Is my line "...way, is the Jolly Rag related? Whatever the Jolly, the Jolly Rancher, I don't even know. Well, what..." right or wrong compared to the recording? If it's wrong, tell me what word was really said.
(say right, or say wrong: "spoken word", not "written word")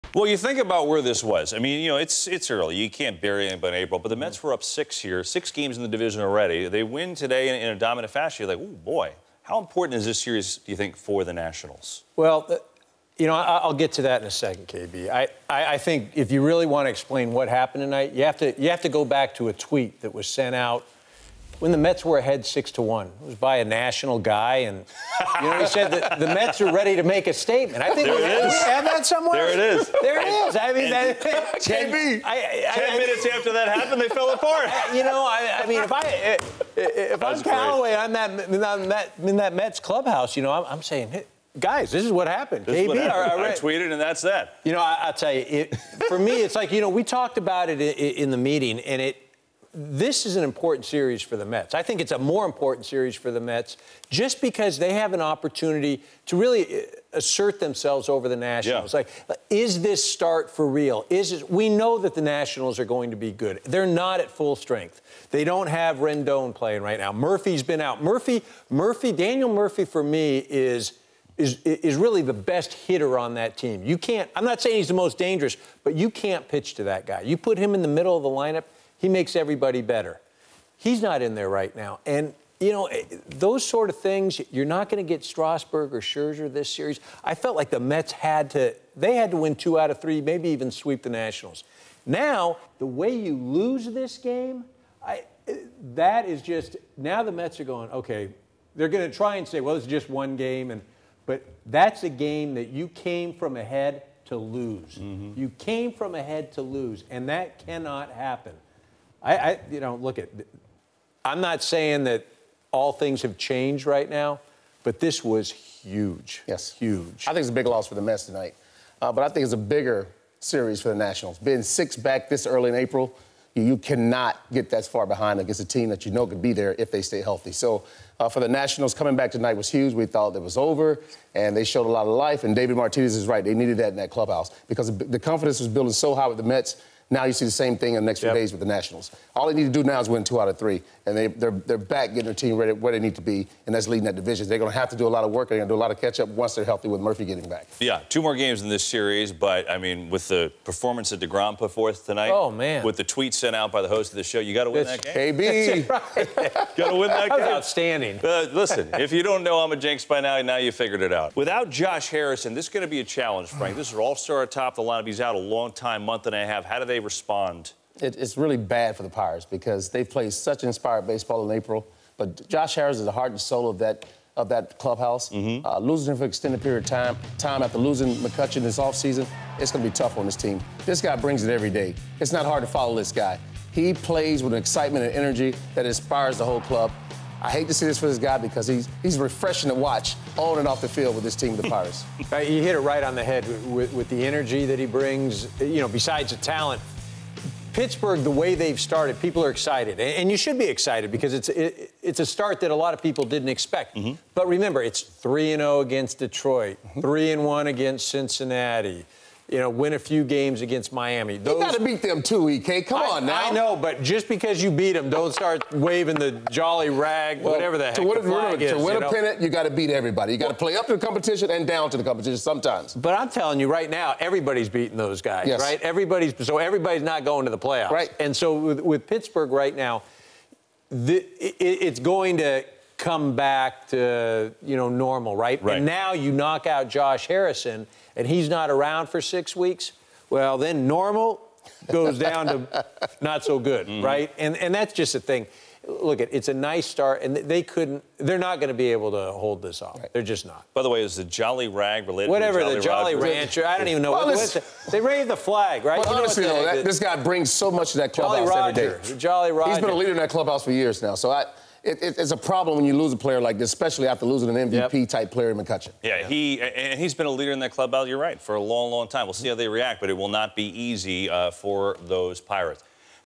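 right.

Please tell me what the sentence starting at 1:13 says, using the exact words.
You can't, I'm not saying he's the most dangerous, but you can't pitch to that guy.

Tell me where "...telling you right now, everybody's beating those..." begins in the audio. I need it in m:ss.
3:43.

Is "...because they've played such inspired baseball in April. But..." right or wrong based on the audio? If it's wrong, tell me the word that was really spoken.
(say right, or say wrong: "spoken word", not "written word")
right.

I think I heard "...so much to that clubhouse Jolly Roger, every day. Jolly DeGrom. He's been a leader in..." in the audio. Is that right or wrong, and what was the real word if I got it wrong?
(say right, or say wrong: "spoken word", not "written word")
wrong: "Roger", not "DeGrom".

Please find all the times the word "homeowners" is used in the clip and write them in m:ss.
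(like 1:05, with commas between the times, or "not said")
not said.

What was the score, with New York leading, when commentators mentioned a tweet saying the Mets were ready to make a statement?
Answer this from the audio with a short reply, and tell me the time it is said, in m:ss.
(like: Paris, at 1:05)
6-1, at 0:22.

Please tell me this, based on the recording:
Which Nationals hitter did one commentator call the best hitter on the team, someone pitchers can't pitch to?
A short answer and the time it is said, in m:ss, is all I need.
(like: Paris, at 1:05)
Daniel Murphy, at 1:09.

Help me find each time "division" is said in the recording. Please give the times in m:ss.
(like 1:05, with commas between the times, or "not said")
0:05, 2:24.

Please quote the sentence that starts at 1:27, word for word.
I felt like the Mets had to, they had to win two out of three, maybe even sweep the Nationals.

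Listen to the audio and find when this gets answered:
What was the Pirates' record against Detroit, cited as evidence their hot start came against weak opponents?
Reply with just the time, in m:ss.
3:25.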